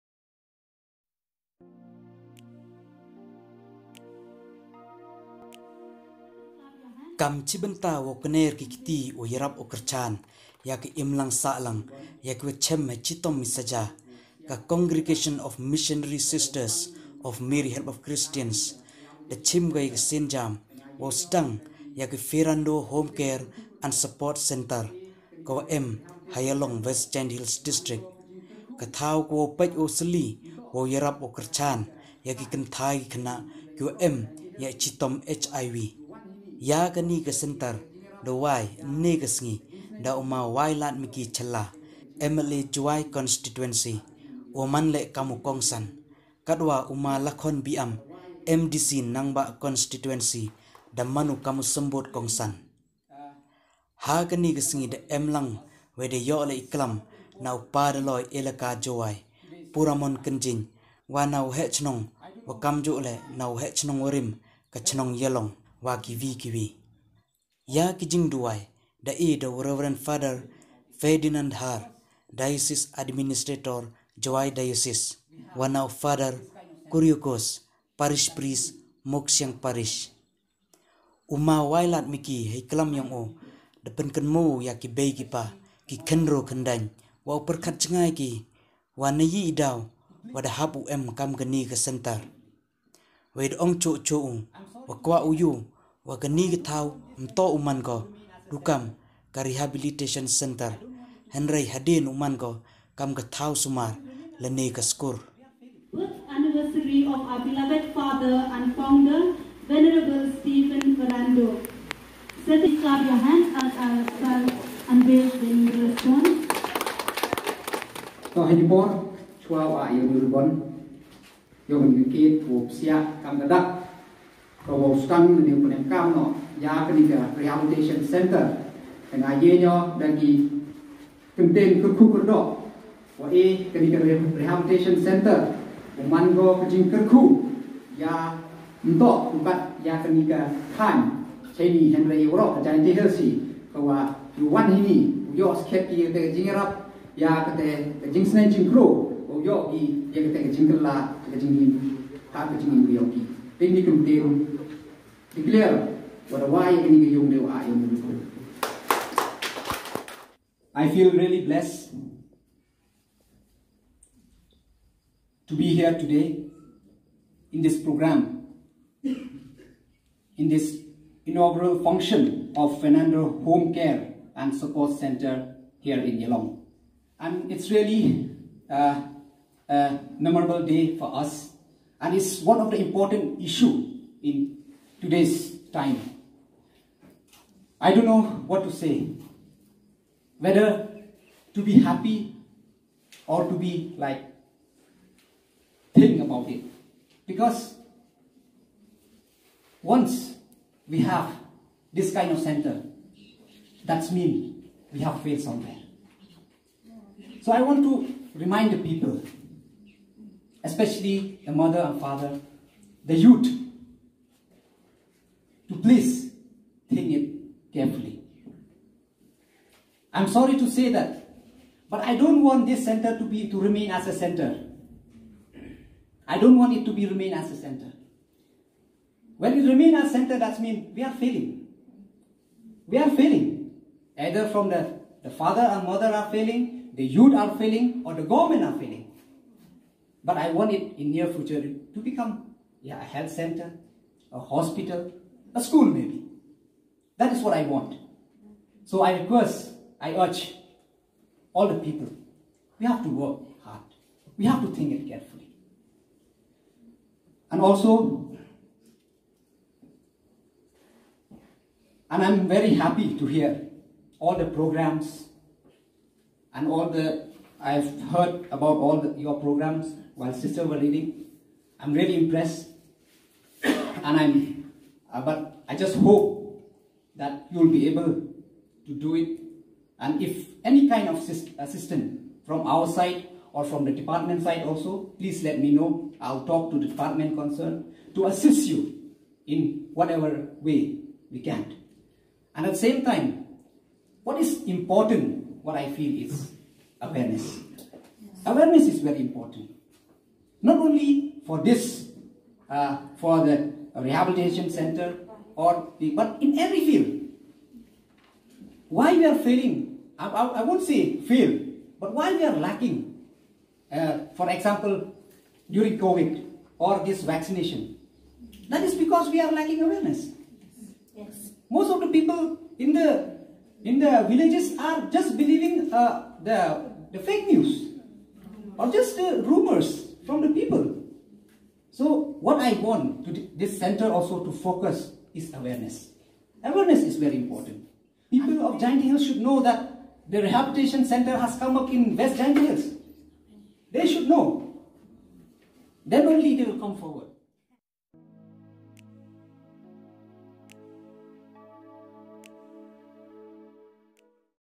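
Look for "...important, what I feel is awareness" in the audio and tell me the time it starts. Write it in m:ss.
4:54.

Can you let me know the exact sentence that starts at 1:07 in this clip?
Ya kijing duwai, da i da Reverend Father Ferdinand Har, Diocese Administrator Jawai Diocese, one of Father Kuryukos, Parish Priest Moksyang Parish.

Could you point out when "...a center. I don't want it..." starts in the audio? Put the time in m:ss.
3:44.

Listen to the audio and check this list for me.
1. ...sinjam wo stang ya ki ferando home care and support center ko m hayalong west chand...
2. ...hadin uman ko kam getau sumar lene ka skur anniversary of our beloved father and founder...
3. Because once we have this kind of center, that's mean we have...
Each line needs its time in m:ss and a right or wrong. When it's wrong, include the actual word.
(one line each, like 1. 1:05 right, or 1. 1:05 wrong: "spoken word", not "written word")
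1. 0:19 right
2. 1:41 right
3. 3:17 right.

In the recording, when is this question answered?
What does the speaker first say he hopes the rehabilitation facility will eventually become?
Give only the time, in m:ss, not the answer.
4:03.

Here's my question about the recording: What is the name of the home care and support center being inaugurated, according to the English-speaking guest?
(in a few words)
Ferrando Home Care and Support Center.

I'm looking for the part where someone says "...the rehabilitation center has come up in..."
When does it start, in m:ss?
5:40.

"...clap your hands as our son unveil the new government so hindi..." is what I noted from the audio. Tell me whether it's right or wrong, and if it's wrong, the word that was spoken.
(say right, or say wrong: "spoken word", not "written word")
wrong: "restaurant", not "government".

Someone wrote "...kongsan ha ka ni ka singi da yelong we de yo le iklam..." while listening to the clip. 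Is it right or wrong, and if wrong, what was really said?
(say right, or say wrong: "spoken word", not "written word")
wrong: "emlang", not "yelong".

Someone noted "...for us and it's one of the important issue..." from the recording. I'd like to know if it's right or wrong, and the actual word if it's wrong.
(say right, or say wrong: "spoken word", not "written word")
right.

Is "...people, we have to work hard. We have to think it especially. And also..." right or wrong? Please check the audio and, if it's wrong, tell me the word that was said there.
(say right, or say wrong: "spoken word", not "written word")
wrong: "carefully", not "especially".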